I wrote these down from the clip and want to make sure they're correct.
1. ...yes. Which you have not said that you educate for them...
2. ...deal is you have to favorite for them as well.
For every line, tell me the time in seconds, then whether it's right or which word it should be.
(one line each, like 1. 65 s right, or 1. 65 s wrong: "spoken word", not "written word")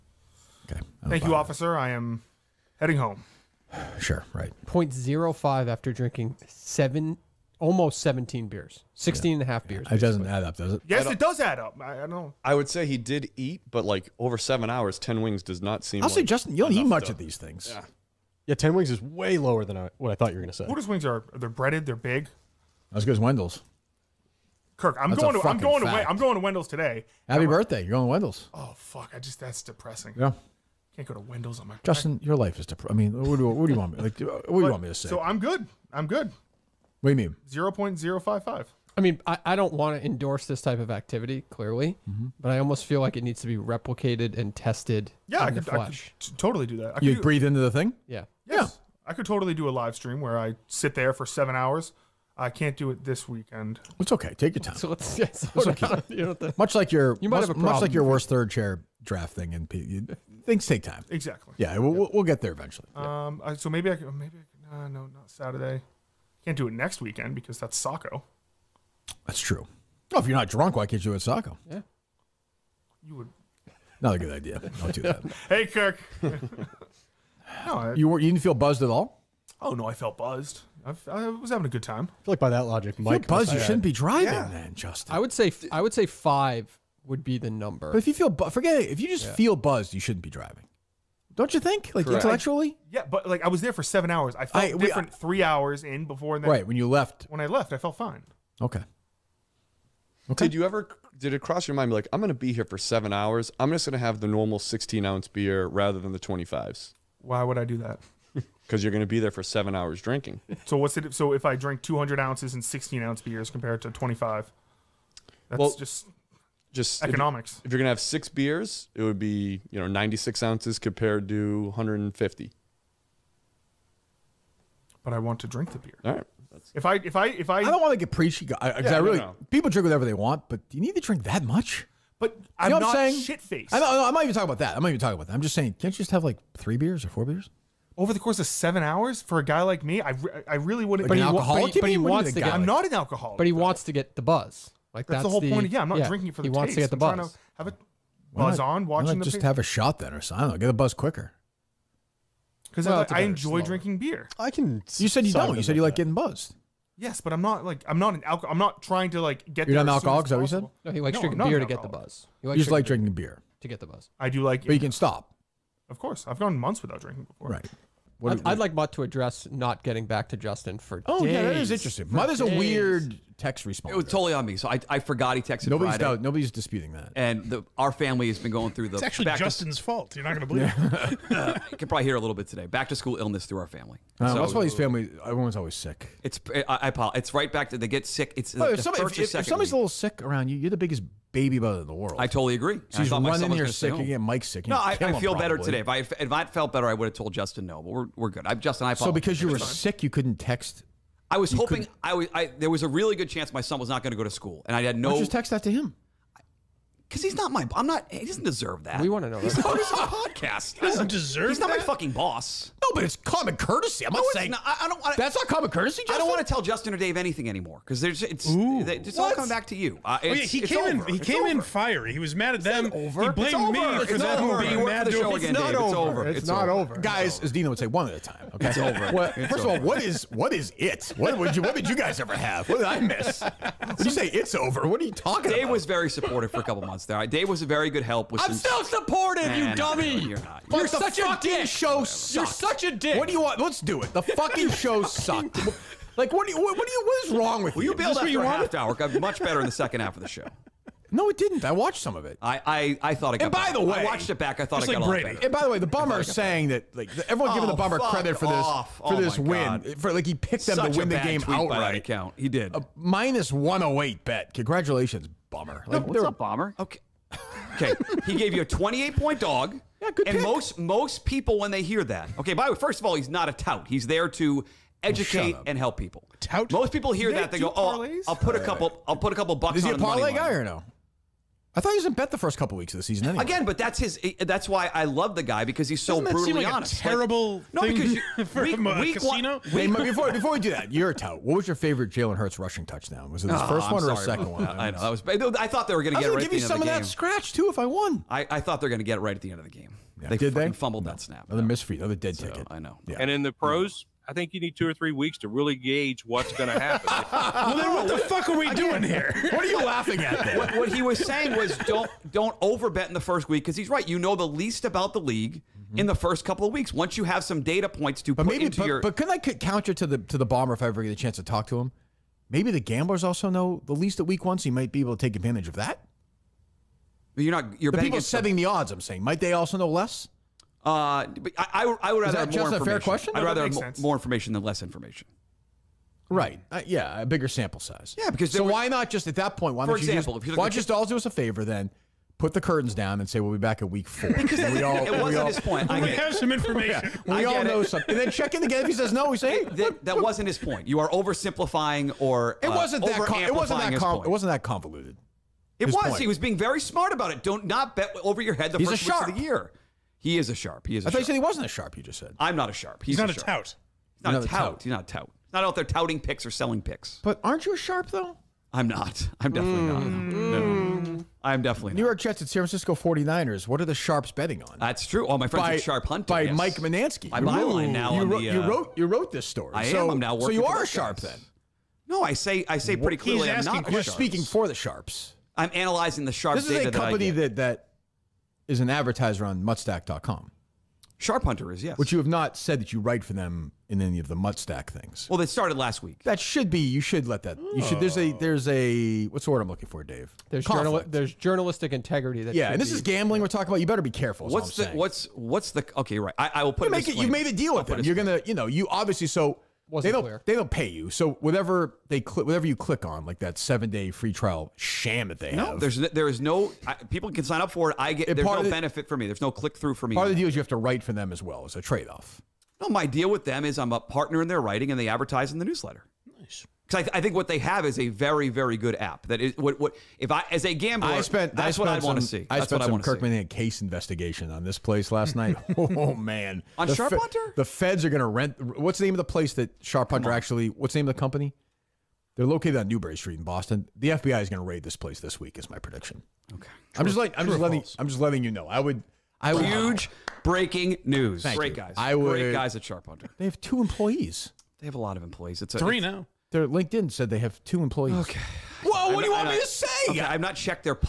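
1. 391 s wrong: "write", not "educate"
2. 420 s wrong: "write", not "favorite".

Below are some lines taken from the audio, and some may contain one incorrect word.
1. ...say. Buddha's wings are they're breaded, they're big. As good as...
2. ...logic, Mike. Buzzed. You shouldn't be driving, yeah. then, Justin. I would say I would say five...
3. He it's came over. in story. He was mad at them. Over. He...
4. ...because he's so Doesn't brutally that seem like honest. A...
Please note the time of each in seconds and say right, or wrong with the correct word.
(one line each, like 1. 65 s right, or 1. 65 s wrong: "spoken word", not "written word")
1. 20 s right
2. 82 s right
3. 221 s wrong: "fiery", not "story"
4. 285 s right.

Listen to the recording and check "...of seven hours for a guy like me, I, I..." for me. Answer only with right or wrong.
right.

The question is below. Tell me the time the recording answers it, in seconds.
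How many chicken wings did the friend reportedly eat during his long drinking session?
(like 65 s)
14 s.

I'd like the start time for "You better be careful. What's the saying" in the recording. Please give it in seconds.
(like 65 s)
403 s.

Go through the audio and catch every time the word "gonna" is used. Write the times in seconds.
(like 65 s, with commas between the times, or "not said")
117 s, 408 s.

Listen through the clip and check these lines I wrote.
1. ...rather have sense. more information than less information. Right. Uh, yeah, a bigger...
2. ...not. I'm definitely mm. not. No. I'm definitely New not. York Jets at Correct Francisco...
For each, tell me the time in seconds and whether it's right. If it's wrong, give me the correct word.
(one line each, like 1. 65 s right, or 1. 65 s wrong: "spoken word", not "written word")
1. 333 s right
2. 368 s wrong: "San", not "Correct".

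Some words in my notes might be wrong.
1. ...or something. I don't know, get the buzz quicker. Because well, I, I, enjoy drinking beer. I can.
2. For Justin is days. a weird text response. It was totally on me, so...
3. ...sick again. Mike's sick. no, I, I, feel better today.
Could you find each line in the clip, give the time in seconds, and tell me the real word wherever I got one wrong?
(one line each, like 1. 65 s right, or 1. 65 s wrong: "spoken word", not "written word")
1. 150 s right
2. 172 s wrong: "Mutt", not "Justin"
3. 193 s right.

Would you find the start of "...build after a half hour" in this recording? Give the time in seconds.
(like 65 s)
247 s.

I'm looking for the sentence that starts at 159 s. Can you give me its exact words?
You're not an alcoholic, is that what you said?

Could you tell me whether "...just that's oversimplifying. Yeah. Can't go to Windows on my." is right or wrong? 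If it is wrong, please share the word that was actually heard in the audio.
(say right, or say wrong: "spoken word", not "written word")
wrong: "depressing", not "oversimplifying".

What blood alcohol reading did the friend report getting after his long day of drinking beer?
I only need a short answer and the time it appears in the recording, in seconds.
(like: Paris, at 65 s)
0.05, at 4 s.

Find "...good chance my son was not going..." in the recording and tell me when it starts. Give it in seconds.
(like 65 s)
203 s.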